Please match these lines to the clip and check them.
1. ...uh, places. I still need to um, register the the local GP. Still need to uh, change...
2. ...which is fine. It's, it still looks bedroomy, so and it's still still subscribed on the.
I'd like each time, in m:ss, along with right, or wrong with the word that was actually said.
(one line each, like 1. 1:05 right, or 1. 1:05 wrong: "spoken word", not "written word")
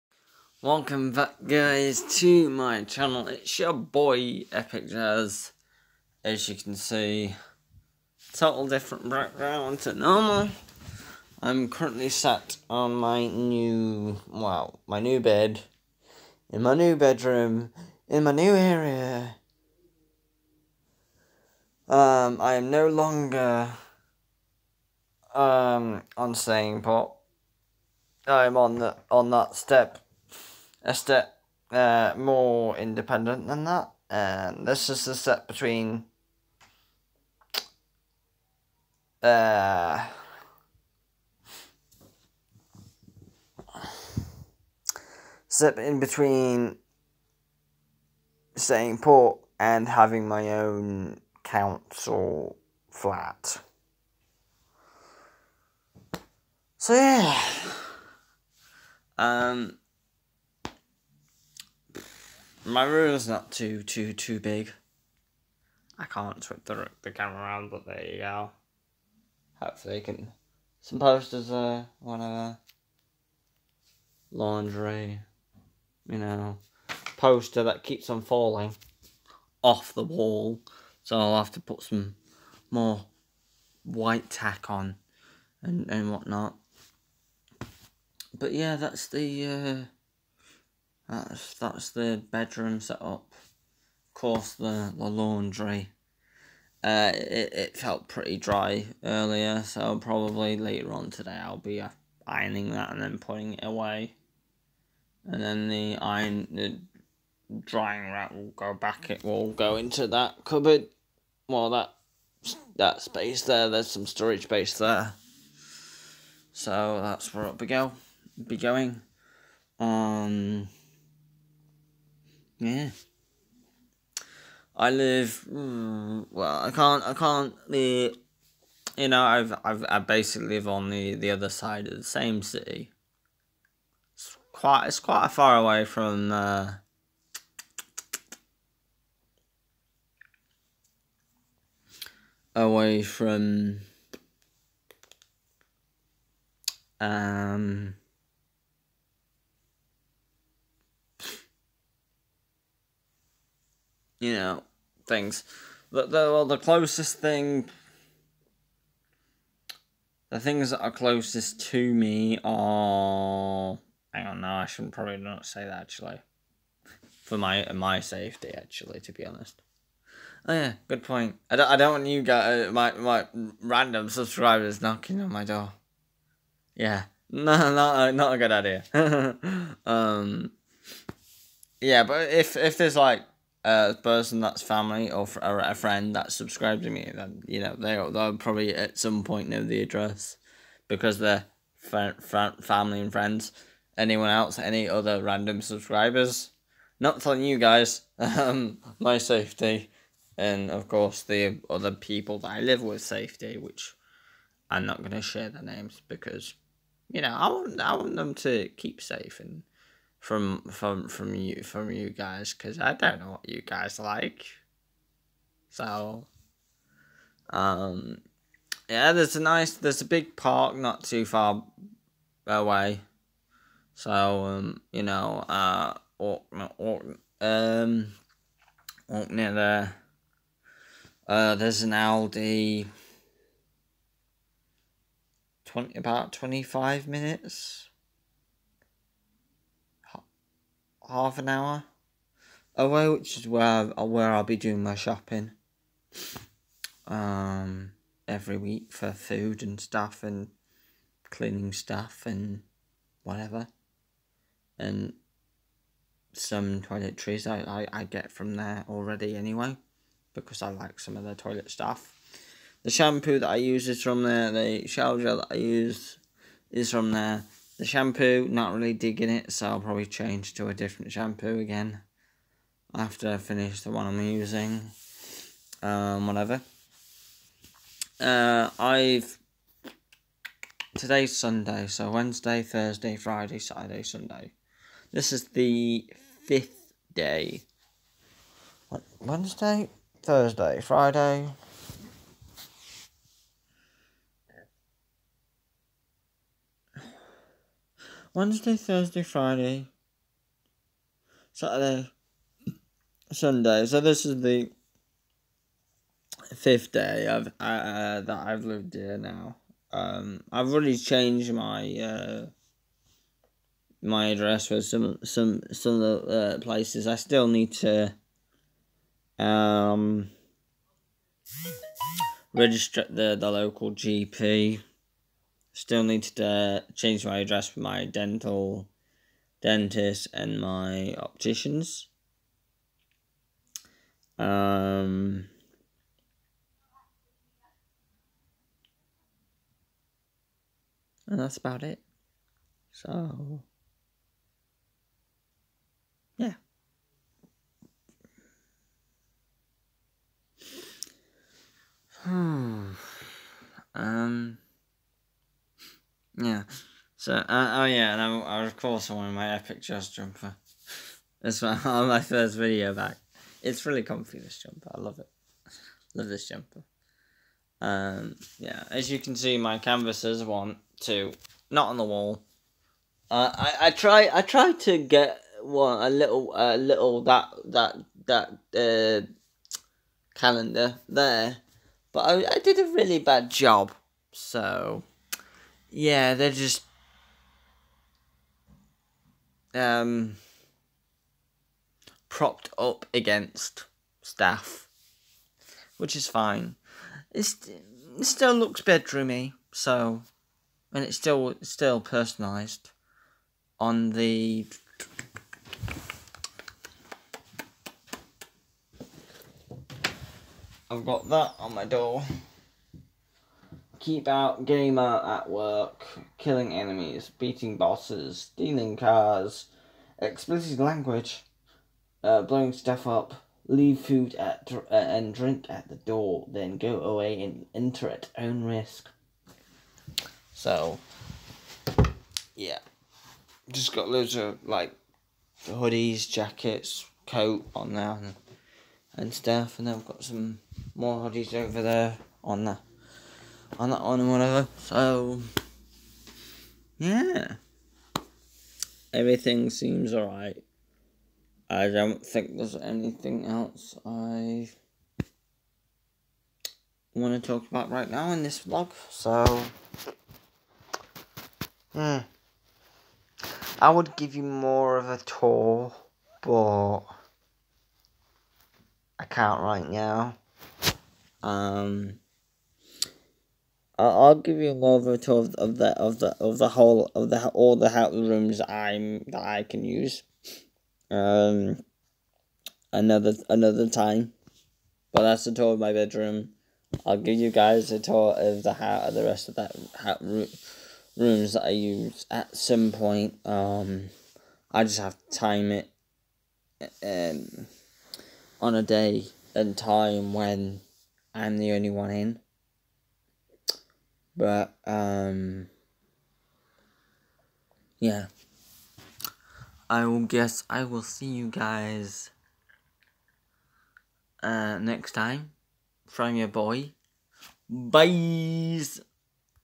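1. 5:16 right
2. 6:35 wrong: "personalised", not "subscribed".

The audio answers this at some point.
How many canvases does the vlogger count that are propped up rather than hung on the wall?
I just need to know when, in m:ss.
6:10.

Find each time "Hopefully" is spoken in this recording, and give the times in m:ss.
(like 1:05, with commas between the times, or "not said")
1:09.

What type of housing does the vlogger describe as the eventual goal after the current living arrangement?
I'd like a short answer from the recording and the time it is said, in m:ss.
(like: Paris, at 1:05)
council flat, at 0:51.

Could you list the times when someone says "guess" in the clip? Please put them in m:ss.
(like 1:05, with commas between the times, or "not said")
8:30.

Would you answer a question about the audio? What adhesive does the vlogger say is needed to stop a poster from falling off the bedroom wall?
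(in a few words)
white tack.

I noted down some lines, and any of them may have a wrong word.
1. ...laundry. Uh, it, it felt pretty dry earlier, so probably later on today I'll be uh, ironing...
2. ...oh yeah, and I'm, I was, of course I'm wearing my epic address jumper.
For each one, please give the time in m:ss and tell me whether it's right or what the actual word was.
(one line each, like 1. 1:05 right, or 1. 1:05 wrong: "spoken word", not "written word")
1. 1:35 right
2. 5:57 wrong: "dress", not "address".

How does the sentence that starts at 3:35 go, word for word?
So, um, yeah, there's a nice there's a big park not too far away.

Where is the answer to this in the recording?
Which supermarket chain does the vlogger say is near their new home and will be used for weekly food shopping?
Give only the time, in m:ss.
3:51.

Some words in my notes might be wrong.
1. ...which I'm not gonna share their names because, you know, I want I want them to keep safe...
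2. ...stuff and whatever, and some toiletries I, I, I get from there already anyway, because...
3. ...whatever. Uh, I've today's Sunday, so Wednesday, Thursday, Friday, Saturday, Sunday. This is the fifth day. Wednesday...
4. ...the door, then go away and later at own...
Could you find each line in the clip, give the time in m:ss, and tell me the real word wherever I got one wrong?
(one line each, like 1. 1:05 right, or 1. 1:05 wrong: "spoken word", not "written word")
1. 3:23 right
2. 4:11 right
3. 4:36 right
4. 7:05 wrong: "enter", not "later".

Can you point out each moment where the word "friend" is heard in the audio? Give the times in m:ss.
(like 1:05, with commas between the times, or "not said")
3:05, 3:13.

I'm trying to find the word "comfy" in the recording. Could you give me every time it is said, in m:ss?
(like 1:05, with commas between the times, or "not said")
6:04.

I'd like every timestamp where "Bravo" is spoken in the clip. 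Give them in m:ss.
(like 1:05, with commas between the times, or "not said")
not said.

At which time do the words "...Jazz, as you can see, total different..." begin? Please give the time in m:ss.
0:04.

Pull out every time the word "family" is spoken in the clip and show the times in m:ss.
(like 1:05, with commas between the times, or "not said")
3:04, 3:11.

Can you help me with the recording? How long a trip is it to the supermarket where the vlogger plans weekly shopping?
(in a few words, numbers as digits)
25 minutes.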